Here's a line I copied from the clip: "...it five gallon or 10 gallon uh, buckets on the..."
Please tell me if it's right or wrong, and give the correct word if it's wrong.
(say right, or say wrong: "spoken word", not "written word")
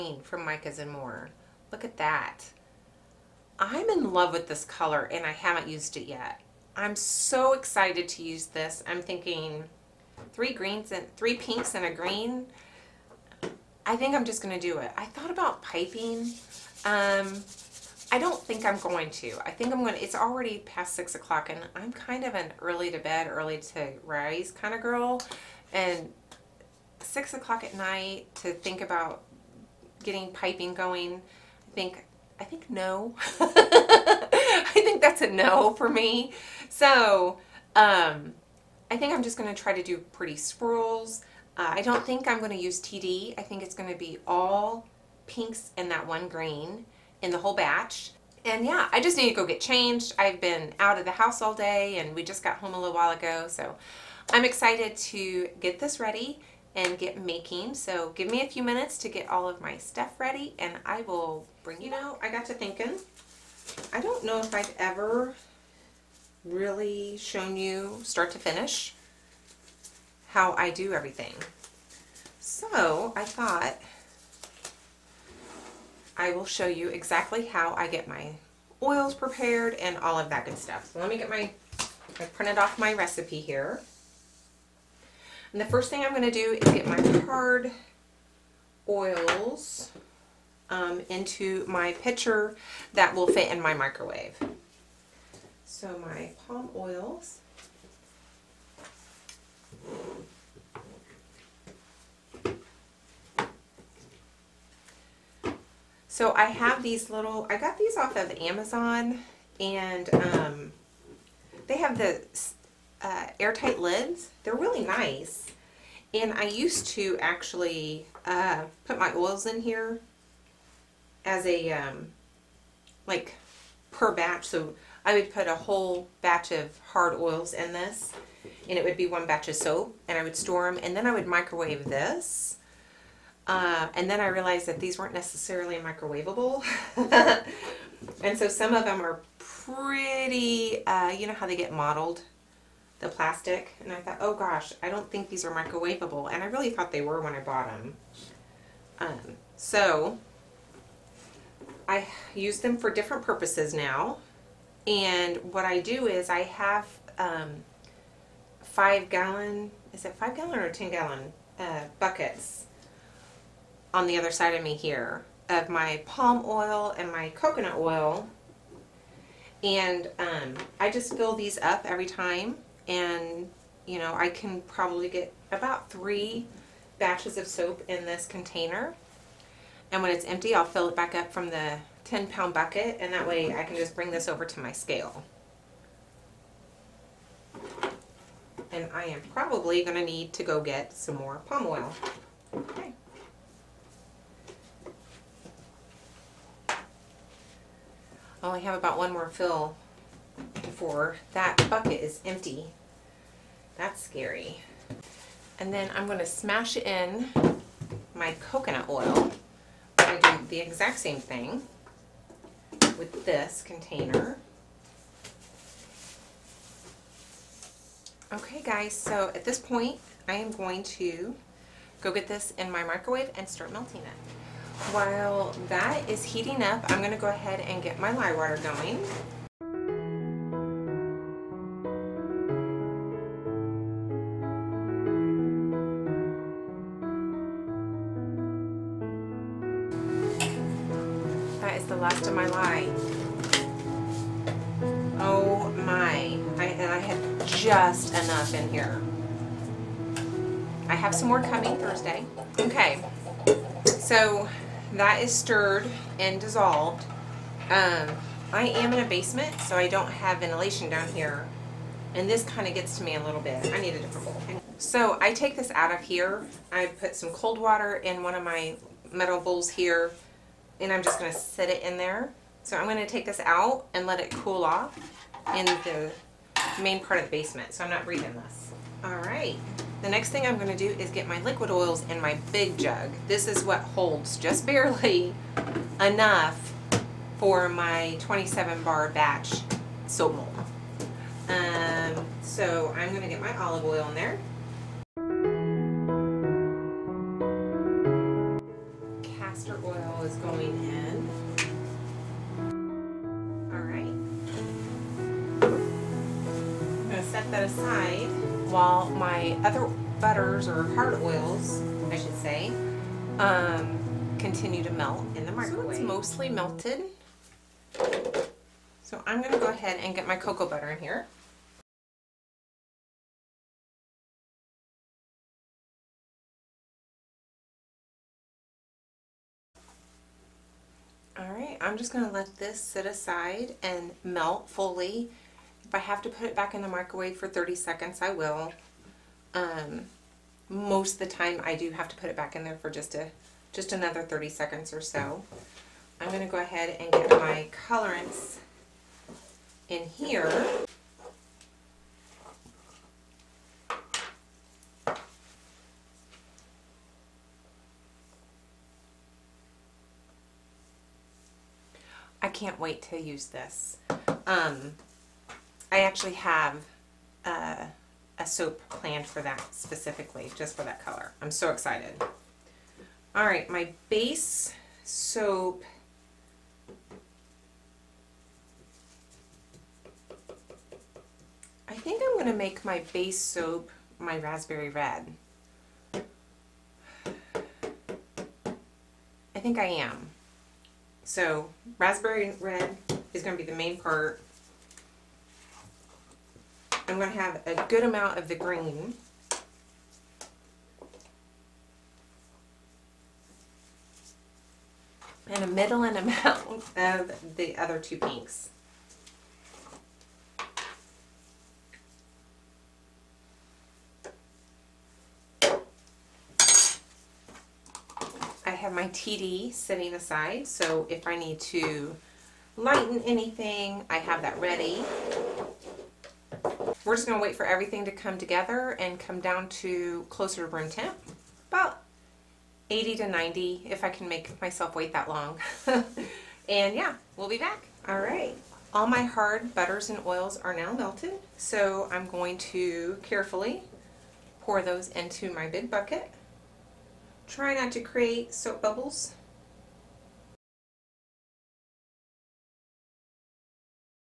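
right.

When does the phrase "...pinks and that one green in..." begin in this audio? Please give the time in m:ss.
0:45.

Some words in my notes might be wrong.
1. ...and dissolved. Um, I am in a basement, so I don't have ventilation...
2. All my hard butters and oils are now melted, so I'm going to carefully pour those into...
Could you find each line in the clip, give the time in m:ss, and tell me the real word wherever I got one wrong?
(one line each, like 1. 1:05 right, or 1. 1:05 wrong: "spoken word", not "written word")
1. 4:16 right
2. 7:18 right.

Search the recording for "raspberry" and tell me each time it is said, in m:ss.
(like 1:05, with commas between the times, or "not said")
6:24, 6:31.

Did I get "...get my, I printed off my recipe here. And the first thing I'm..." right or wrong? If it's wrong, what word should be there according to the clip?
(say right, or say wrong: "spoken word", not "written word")
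right.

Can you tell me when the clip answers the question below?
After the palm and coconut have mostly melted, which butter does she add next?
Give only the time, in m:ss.
5:20.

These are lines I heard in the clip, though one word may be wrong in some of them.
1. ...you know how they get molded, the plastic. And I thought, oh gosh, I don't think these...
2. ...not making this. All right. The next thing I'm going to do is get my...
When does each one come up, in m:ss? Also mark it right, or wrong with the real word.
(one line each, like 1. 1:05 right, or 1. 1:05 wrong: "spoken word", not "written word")
1. 2:21 right
2. 4:37 wrong: "breathing", not "making".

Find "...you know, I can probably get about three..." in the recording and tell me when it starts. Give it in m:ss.
2:53.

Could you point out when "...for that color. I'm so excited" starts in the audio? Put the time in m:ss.
6:10.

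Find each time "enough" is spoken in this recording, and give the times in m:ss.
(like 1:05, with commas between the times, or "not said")
4:08, 4:46.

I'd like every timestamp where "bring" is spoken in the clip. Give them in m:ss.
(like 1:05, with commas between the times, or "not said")
1:01, 3:03.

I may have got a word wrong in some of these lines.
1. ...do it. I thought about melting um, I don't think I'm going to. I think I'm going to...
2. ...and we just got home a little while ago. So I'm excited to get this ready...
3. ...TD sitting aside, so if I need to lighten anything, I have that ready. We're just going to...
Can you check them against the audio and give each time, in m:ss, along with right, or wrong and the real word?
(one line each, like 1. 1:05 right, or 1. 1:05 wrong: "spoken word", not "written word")
1. 0:14 wrong: "piping", not "melting"
2. 0:51 right
3. 6:59 right.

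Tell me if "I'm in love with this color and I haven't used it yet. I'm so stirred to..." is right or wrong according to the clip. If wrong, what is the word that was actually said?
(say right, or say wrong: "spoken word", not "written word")
wrong: "excited", not "stirred".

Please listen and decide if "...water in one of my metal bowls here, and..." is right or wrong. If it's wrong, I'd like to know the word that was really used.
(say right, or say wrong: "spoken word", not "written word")
right.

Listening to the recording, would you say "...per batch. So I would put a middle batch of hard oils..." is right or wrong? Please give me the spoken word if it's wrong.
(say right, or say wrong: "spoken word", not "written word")
wrong: "whole", not "middle".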